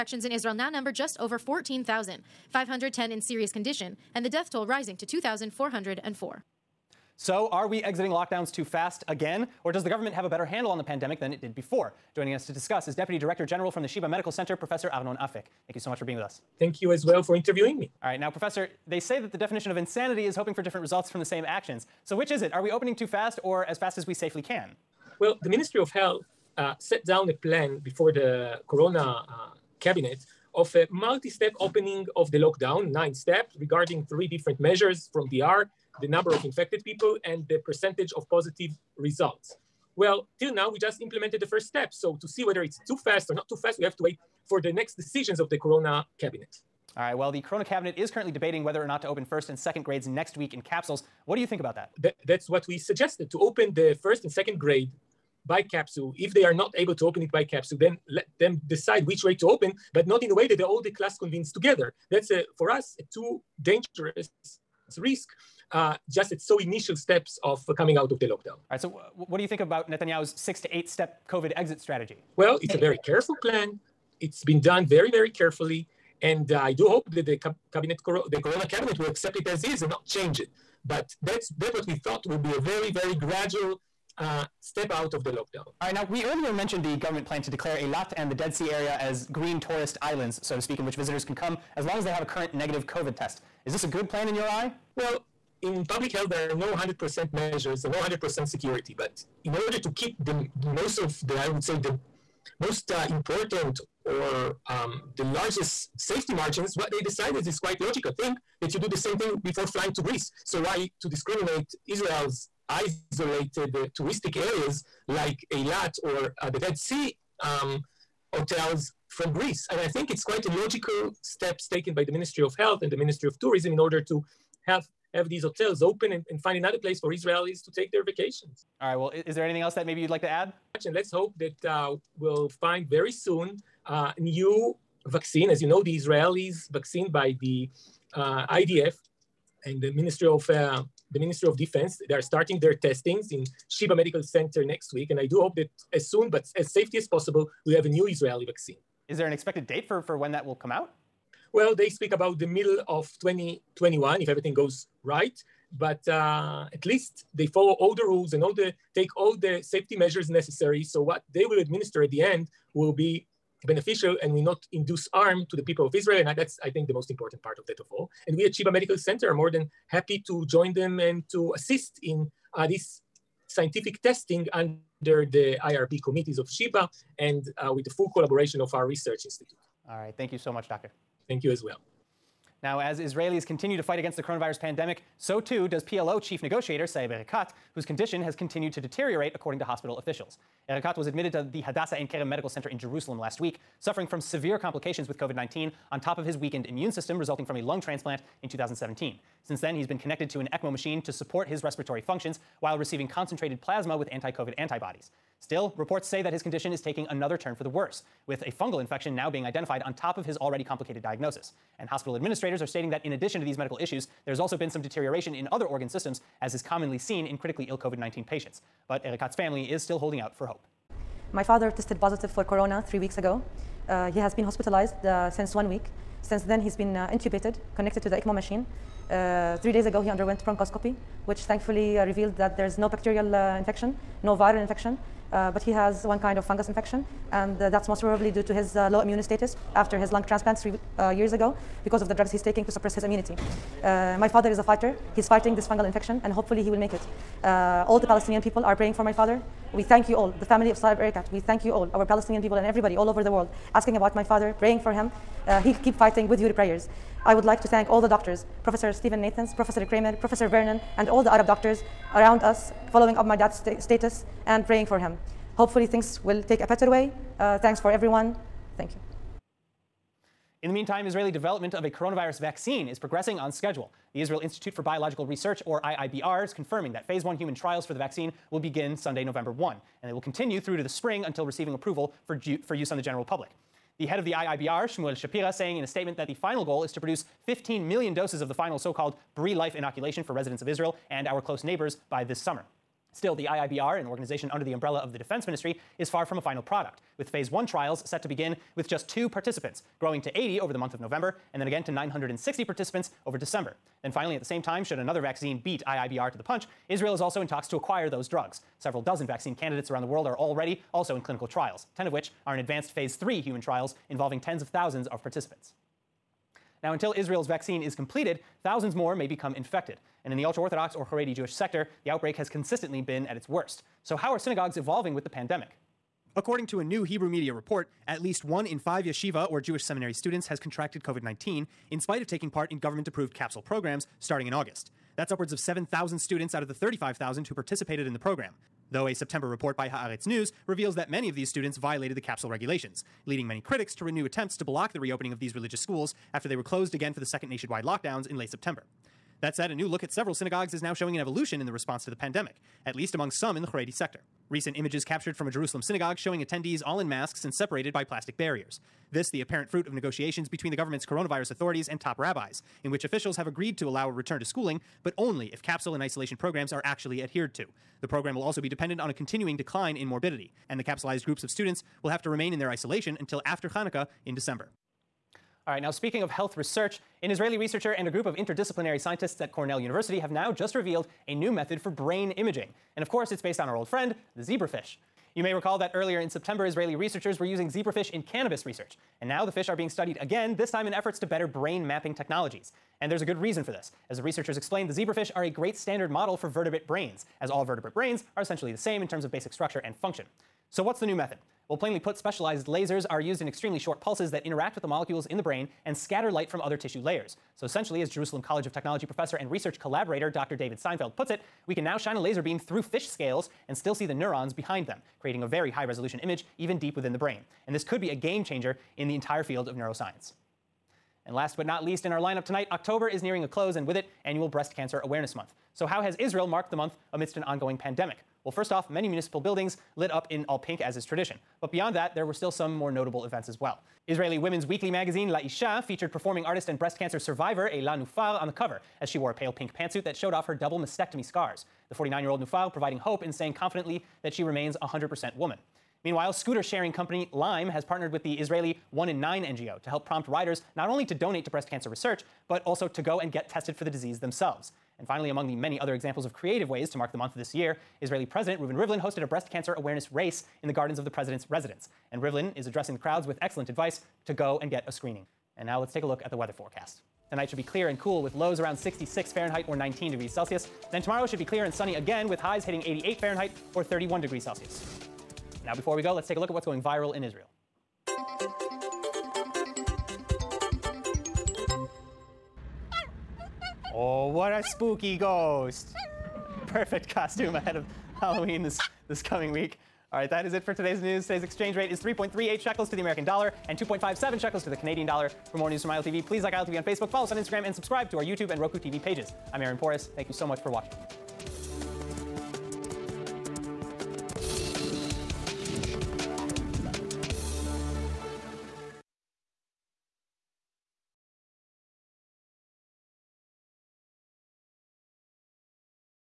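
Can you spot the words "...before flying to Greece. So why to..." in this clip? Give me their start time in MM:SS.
01:49.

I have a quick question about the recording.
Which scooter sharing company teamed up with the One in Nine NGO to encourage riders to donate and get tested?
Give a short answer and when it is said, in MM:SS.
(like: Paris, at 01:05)
Lime, at 07:27.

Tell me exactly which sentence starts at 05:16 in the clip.
Now, until Israel's vaccine is completed, thousands more may become infected.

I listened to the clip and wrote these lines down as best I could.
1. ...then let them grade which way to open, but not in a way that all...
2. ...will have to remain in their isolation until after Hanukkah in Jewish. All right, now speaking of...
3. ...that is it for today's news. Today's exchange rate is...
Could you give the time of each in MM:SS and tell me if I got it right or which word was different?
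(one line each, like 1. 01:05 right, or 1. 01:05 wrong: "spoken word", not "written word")
1. 00:57 wrong: "decide", not "grade"
2. 06:12 wrong: "December", not "Jewish"
3. 08:10 right.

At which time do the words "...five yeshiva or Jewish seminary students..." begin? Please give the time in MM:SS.
05:28.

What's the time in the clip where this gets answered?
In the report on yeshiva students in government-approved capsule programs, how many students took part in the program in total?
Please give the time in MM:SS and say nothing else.
05:36.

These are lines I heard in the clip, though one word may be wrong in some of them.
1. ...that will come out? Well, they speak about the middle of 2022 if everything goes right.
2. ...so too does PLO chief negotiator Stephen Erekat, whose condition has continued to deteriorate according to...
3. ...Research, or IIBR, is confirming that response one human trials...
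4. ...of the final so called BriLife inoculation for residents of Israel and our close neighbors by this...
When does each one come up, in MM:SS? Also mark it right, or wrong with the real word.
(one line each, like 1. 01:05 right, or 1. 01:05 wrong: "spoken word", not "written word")
1. 02:30 wrong: "2021", not "2022"
2. 03:05 wrong: "Saeb", not "Stephen"
3. 04:35 wrong: "phase", not "response"
4. 04:48 right.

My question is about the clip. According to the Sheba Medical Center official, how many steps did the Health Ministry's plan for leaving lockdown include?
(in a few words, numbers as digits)
9.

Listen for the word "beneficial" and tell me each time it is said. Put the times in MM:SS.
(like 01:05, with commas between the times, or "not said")
02:43.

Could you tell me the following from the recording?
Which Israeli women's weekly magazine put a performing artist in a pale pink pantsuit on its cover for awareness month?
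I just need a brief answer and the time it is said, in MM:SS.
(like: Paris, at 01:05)
La Isha, at 07:15.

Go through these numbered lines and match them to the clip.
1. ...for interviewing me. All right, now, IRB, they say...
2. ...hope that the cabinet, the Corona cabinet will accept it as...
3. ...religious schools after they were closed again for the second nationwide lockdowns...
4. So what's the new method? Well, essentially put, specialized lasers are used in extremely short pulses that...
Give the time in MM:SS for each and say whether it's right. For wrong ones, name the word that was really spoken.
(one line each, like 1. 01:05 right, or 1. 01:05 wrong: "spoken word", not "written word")
1. 00:17 wrong: "Professor", not "IRB"
2. 01:16 right
3. 05:45 right
4. 06:40 wrong: "plainly", not "essentially".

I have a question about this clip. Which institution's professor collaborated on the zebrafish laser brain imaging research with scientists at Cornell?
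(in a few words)
Jerusalem College of Technology.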